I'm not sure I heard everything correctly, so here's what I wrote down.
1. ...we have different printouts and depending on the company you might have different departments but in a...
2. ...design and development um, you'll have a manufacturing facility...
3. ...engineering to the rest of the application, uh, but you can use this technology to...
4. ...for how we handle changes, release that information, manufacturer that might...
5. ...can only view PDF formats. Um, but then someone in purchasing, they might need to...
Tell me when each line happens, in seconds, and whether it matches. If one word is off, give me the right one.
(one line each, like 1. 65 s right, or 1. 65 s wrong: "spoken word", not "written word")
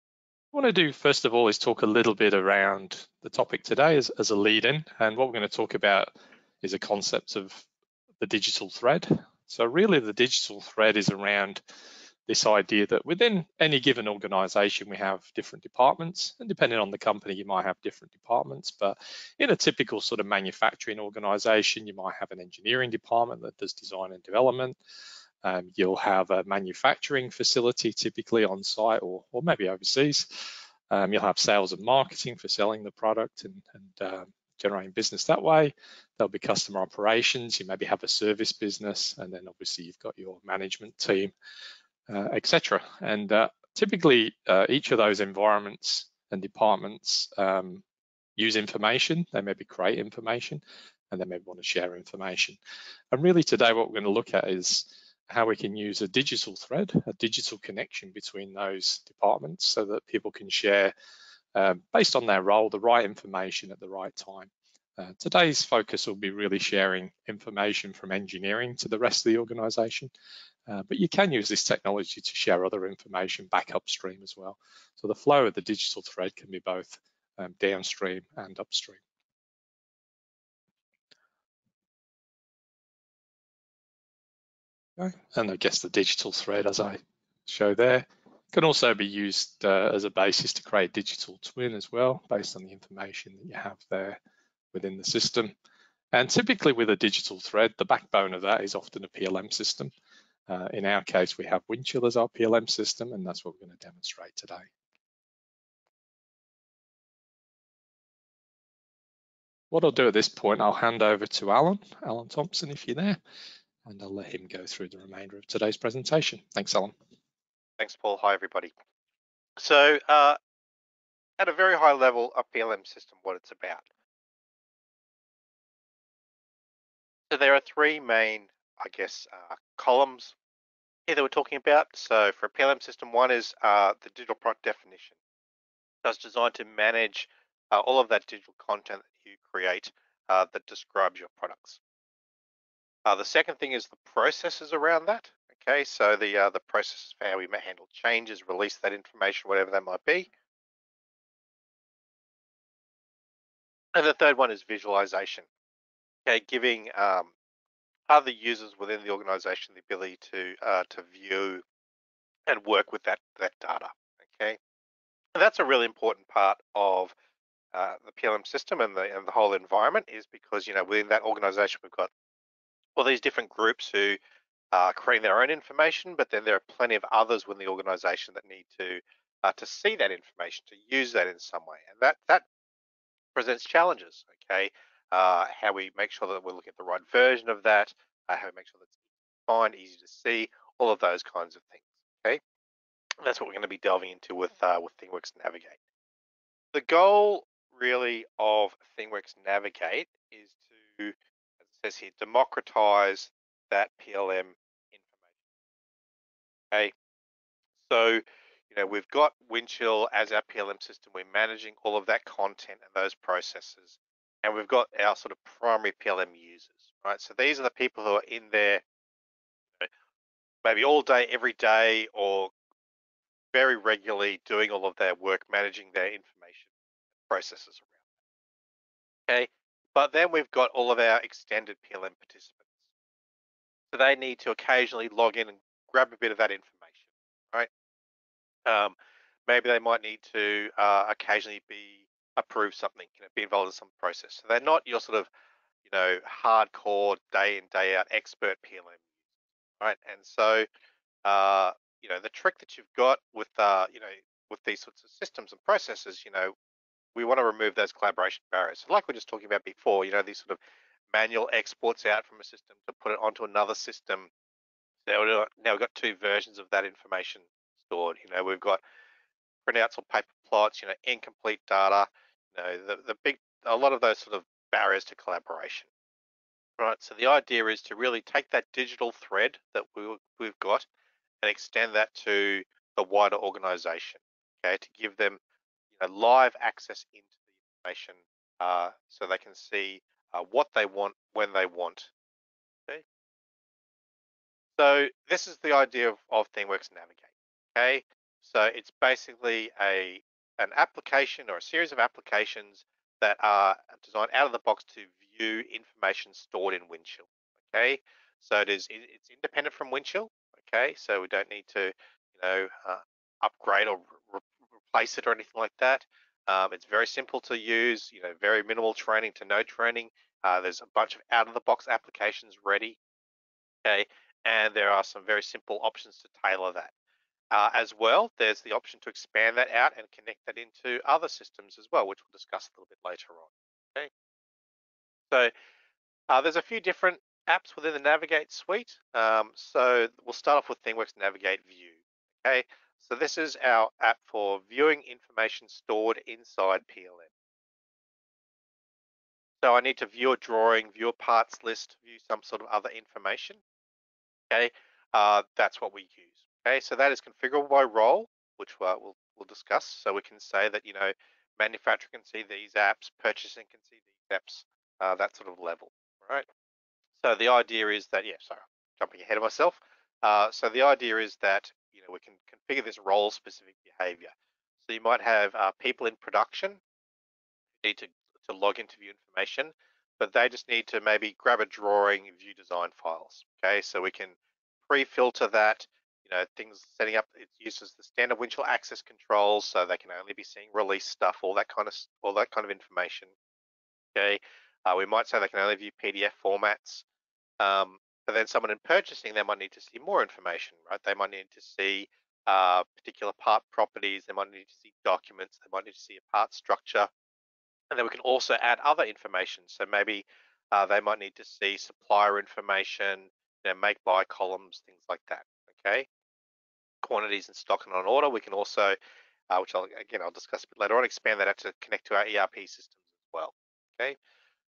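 1. 14 s wrong: "departments", not "printouts"
2. 23 s right
3. 68 s wrong: "organization", not "application"
4. 147 s wrong: "whatever", not "manufacturer"
5. 395 s right.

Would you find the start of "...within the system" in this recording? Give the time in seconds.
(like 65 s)
94 s.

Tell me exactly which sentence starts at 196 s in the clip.
The goal really of ThingWorx Navigate is to says here, democratize that PLM information.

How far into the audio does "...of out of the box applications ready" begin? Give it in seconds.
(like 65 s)
321 s.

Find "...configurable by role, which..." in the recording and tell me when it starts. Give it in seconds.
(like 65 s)
357 s.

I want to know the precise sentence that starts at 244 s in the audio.
So they're not your sort of, you know, hardcore day in day out expert PLM, right?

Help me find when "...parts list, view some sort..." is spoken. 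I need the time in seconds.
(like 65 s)
351 s.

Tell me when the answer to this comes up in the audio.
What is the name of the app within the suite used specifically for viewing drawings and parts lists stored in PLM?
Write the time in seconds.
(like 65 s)
340 s.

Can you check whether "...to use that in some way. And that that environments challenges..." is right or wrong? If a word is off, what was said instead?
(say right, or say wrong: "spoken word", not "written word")
wrong: "presents", not "environments".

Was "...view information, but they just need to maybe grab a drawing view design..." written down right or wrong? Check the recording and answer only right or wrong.
right.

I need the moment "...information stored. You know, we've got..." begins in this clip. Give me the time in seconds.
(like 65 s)
266 s.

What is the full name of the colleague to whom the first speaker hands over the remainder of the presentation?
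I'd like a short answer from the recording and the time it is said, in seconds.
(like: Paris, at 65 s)
Alan Thompson, at 112 s.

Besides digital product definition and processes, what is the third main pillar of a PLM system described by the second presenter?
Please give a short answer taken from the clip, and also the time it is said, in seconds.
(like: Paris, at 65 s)
Visualization, at 154 s.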